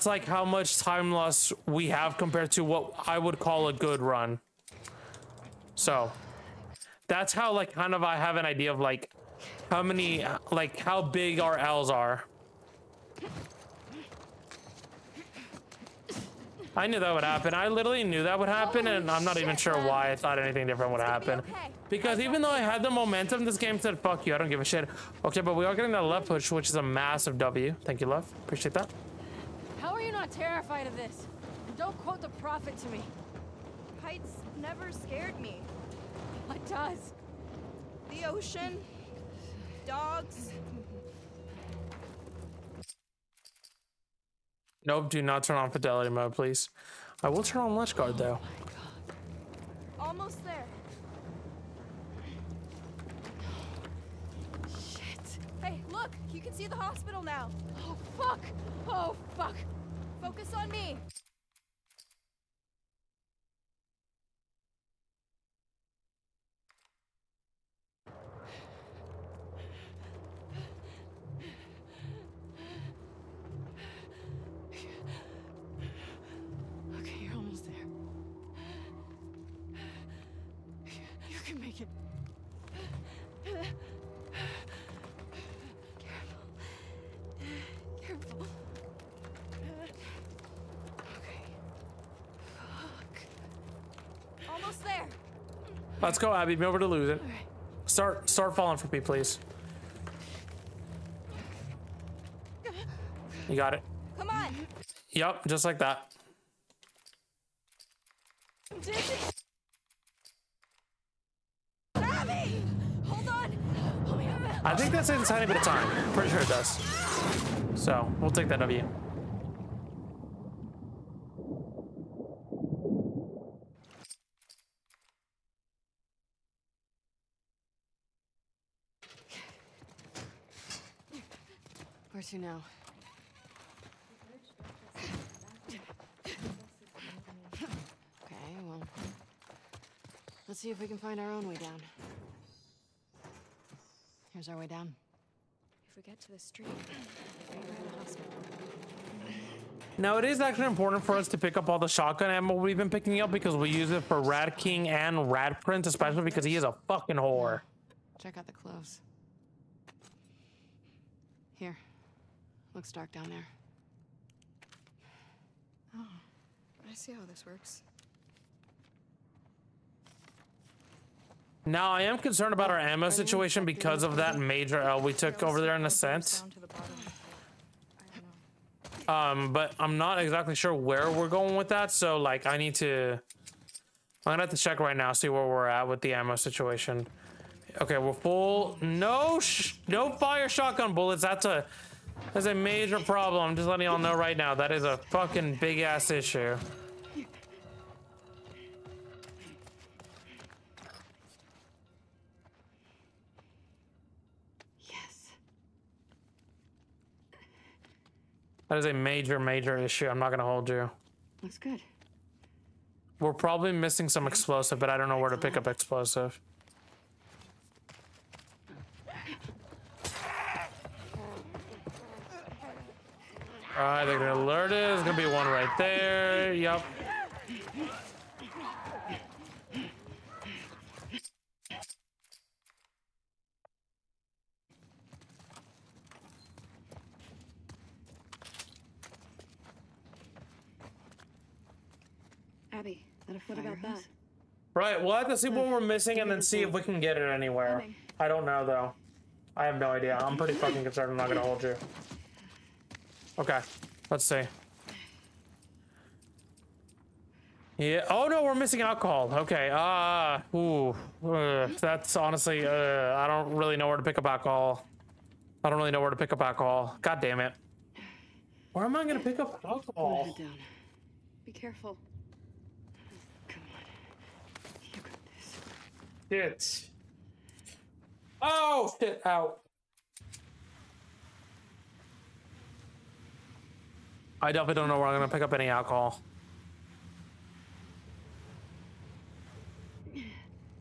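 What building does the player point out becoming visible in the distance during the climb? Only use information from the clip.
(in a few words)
The hospital.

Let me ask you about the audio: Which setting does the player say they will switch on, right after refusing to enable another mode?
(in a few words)
Lynch Guard.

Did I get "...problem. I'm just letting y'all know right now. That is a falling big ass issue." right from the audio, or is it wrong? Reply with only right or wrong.
wrong.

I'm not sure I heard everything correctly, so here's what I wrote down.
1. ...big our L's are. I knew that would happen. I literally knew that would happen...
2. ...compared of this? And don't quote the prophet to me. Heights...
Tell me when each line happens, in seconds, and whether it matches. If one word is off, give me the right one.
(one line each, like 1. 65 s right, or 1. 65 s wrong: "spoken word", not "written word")
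1. 10 s right
2. 30 s wrong: "terrified", not "compared".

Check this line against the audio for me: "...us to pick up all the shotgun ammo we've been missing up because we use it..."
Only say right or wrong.
wrong.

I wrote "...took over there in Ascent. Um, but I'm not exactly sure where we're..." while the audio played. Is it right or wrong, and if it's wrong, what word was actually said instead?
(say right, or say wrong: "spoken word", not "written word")
right.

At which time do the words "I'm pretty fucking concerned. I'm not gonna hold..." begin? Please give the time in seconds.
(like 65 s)
250 s.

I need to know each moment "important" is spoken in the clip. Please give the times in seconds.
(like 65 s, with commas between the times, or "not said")
150 s.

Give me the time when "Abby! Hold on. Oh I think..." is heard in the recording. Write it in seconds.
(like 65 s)
111 s.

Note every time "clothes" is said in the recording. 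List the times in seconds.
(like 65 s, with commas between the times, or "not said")
158 s.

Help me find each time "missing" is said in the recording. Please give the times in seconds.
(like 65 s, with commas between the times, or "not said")
213 s, 245 s, 258 s.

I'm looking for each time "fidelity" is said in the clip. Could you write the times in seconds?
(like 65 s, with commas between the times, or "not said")
45 s.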